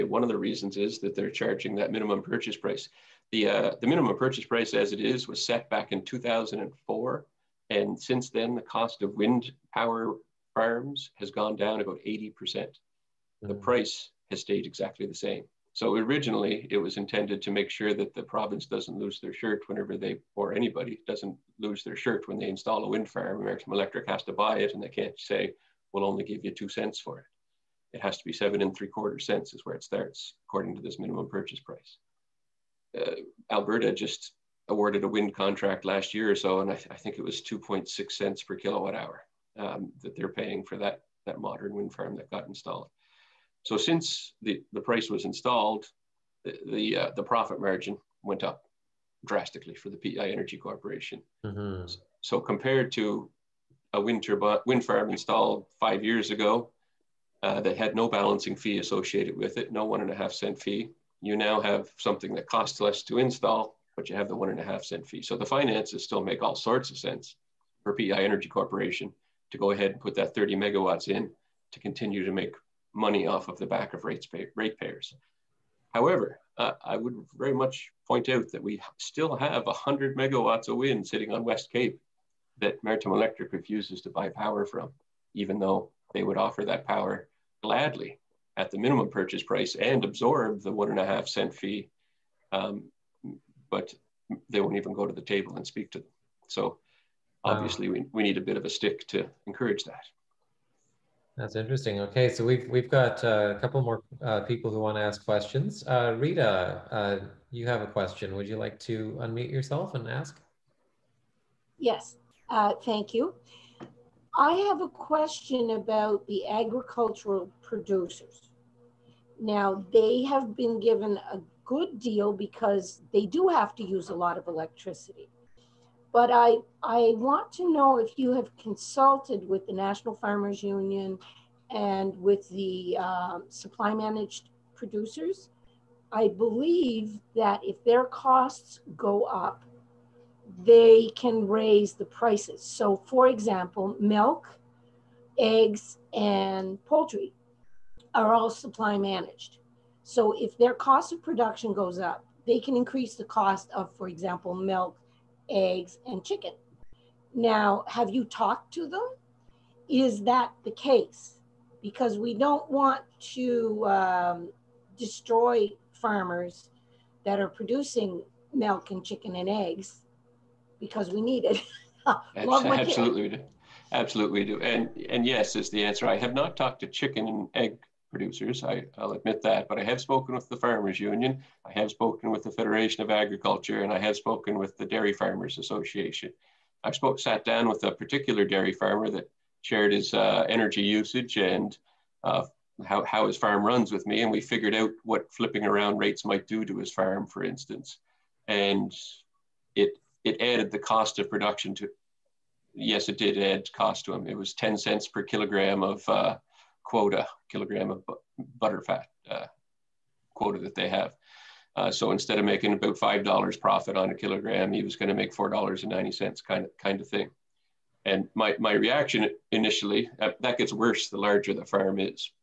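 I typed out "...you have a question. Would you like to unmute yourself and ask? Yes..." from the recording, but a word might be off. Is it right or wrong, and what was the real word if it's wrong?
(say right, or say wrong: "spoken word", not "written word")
right.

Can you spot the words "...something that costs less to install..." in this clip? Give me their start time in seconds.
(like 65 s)
61 s.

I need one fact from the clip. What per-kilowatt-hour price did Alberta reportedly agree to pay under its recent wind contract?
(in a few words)
2.6 cents.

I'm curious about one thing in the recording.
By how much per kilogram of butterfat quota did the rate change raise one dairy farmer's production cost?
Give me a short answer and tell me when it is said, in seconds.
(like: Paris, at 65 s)
10 cents, at 204 s.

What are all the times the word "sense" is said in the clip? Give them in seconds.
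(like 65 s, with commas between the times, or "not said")
66 s.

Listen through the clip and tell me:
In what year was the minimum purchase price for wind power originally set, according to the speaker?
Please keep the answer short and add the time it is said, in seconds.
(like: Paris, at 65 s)
2004, at 6 s.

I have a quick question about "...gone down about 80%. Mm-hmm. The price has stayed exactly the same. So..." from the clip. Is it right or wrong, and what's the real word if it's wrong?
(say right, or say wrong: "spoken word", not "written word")
right.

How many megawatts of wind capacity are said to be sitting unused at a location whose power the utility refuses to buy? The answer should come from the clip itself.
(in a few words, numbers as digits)
100 megawatts.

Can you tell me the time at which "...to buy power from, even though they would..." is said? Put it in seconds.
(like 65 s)
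84 s.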